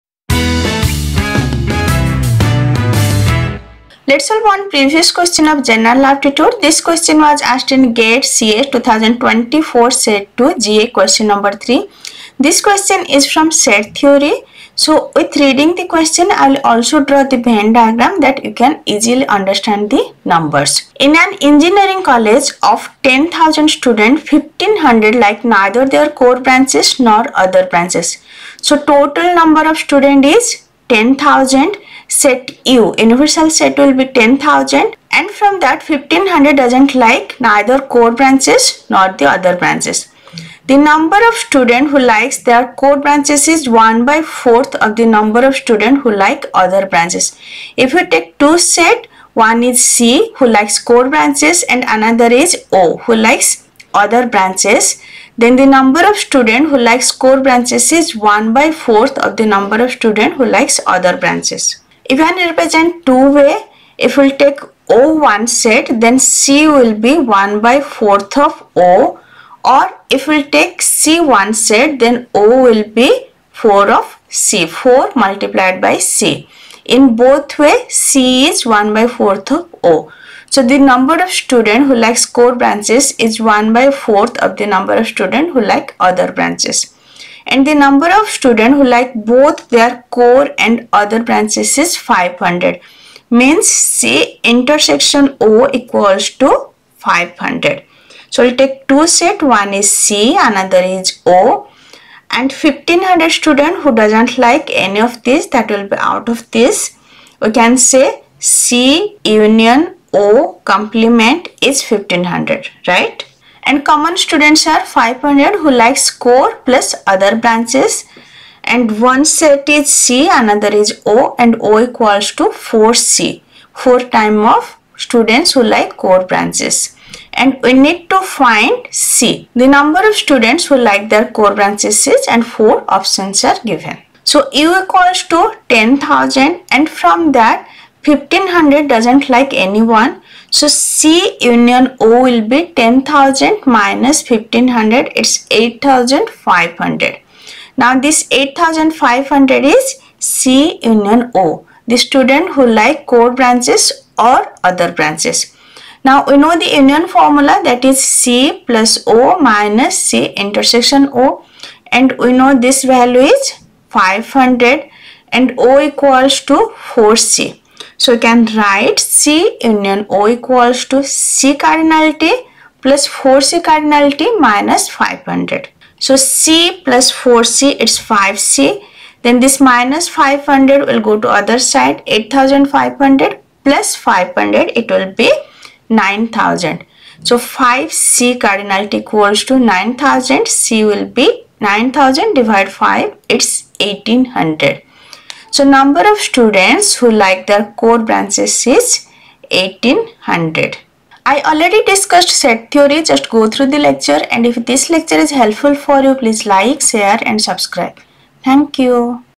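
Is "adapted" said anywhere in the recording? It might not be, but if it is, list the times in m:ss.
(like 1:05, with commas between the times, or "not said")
not said.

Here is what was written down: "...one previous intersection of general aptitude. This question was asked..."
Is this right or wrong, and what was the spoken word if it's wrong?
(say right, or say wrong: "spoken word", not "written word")
wrong: "question", not "intersection".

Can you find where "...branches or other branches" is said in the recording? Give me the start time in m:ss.
2:33.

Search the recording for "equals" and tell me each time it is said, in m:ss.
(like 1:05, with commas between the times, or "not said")
1:35, 2:01, 2:14, 2:45, 2:50, 3:09.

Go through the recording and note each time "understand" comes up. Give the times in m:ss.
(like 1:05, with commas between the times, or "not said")
0:19.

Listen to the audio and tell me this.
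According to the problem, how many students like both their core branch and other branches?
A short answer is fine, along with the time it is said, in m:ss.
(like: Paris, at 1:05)
500, at 1:29.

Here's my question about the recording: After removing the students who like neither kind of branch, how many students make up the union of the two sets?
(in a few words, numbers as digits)
8500.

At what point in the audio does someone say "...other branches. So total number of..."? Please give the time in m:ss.
0:27.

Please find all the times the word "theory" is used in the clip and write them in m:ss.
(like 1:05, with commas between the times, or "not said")
0:13, 3:22.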